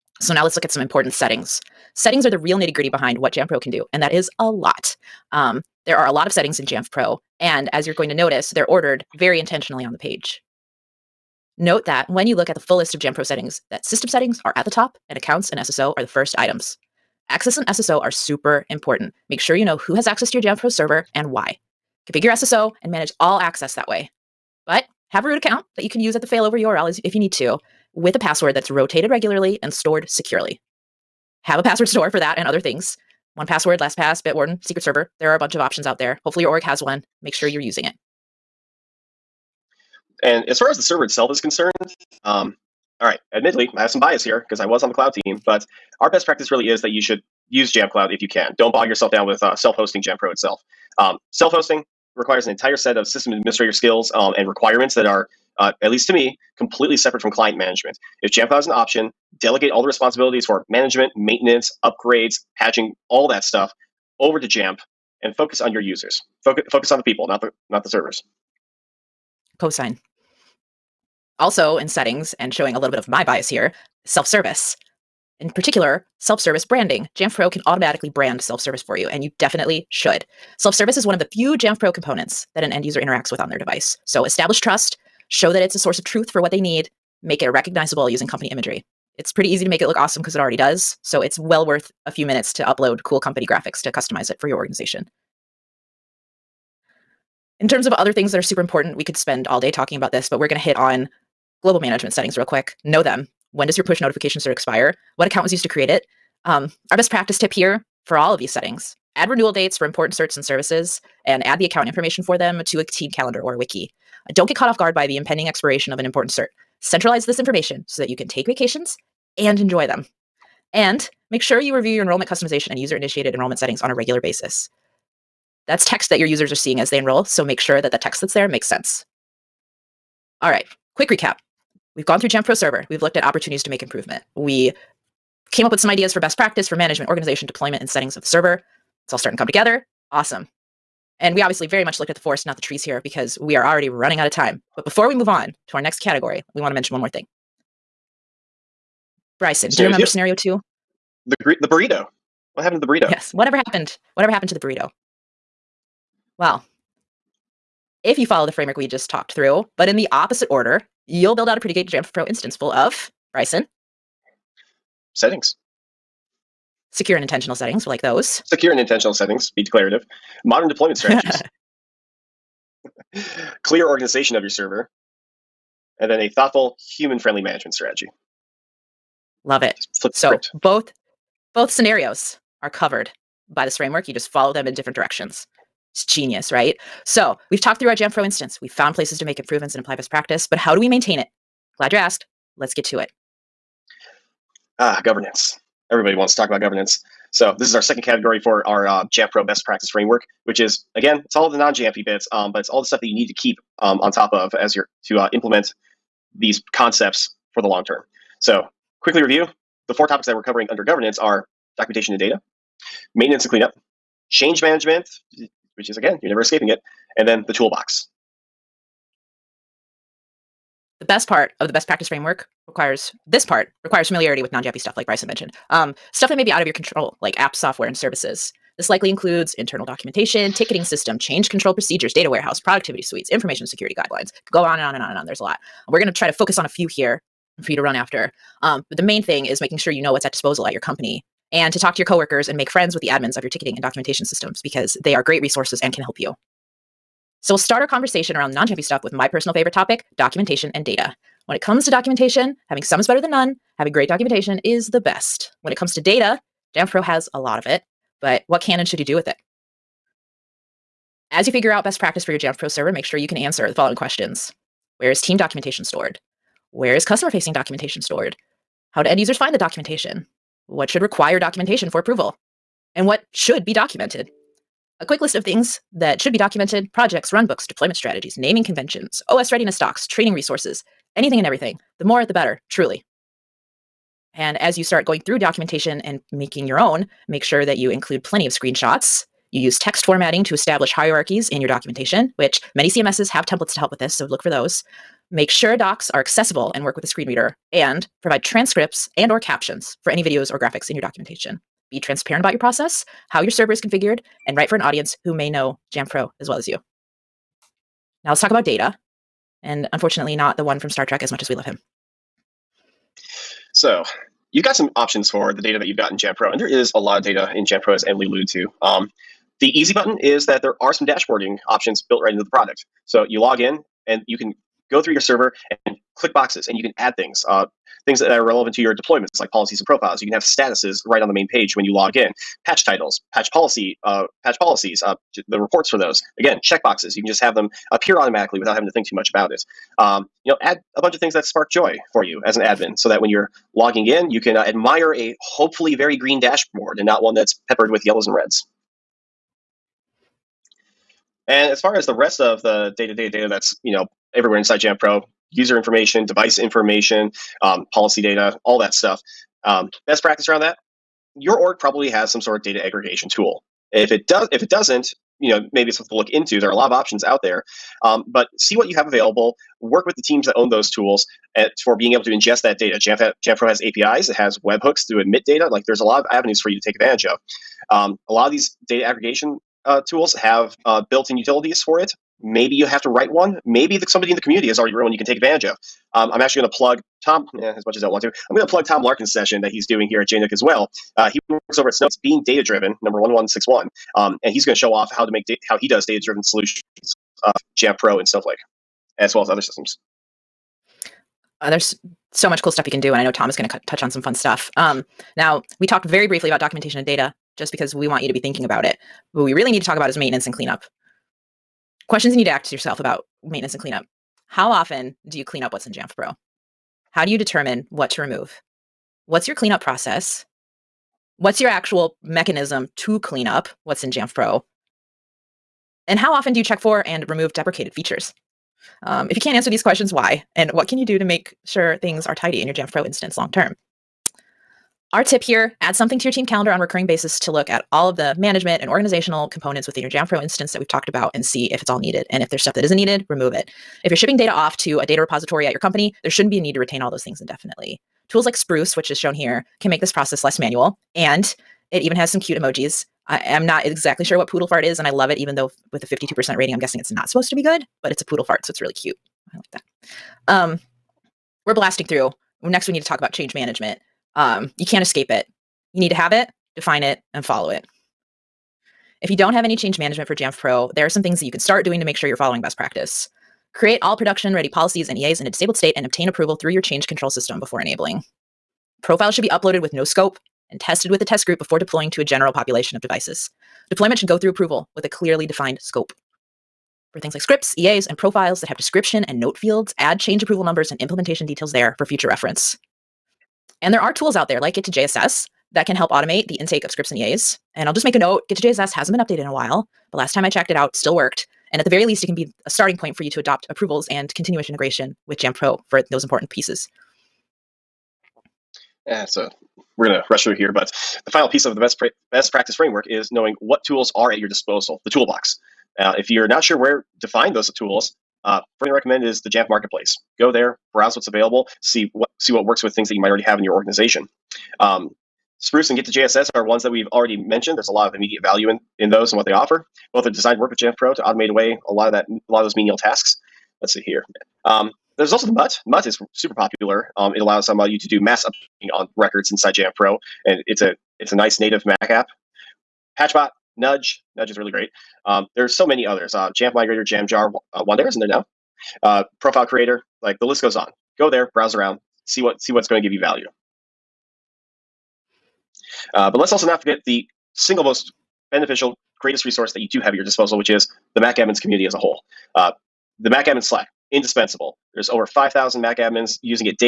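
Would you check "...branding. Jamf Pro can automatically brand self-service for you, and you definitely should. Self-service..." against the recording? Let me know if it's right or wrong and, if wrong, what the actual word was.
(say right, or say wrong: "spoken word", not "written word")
right.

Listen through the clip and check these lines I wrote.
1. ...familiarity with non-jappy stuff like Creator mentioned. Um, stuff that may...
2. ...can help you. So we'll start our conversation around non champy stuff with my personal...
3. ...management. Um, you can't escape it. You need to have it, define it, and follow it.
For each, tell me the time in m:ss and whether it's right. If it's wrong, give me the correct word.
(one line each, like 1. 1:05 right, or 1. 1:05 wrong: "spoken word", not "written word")
1. 3:44 wrong: "Bryson", not "Creator"
2. 4:05 right
3. 7:43 right.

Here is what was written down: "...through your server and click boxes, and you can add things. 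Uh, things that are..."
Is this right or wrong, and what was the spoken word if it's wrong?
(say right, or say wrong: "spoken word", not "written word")
right.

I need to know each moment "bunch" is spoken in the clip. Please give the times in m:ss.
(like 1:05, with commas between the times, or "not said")
0:35, 5:41.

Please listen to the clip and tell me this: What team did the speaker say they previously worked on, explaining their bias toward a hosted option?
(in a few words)
The cloud team.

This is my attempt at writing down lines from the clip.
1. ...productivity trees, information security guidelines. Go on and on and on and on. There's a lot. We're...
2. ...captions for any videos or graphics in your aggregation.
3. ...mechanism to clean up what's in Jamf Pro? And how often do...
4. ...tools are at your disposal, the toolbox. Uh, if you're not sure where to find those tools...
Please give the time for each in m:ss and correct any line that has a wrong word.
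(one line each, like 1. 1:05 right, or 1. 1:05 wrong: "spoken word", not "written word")
1. 3:52 wrong: "suites", not "trees"
2. 4:59 wrong: "documentation", not "aggregation"
3. 7:02 right
4. 8:33 right.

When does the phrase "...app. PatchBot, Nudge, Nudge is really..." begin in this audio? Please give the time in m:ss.
9:02.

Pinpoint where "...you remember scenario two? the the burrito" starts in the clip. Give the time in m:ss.
2:29.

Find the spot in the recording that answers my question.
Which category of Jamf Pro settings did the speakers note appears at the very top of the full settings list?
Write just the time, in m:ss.
0:13.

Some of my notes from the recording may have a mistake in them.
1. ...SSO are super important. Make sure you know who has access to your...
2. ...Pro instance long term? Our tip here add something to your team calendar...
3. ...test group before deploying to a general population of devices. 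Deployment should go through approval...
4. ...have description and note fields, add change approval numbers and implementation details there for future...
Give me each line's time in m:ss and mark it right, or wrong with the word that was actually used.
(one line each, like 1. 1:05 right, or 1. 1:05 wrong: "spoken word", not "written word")
1. 0:17 right
2. 7:12 right
3. 8:01 right
4. 8:08 right.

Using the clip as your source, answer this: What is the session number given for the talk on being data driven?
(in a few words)
1161.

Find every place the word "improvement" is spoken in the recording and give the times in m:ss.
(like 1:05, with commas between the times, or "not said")
2:13, 3:09.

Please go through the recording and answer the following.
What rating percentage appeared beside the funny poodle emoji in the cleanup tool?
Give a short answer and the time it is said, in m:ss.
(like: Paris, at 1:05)
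52%, at 7:36.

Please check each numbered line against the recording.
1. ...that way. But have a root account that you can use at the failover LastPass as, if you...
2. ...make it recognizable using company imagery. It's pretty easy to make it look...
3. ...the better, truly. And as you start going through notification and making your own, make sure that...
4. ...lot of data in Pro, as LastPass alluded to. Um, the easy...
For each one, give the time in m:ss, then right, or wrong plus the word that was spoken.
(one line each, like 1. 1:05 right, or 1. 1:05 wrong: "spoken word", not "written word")
1. 0:23 wrong: "URL", not "LastPass"
2. 1:27 right
3. 4:42 wrong: "documentation", not "notification"
4. 5:16 wrong: "Emily", not "LastPass".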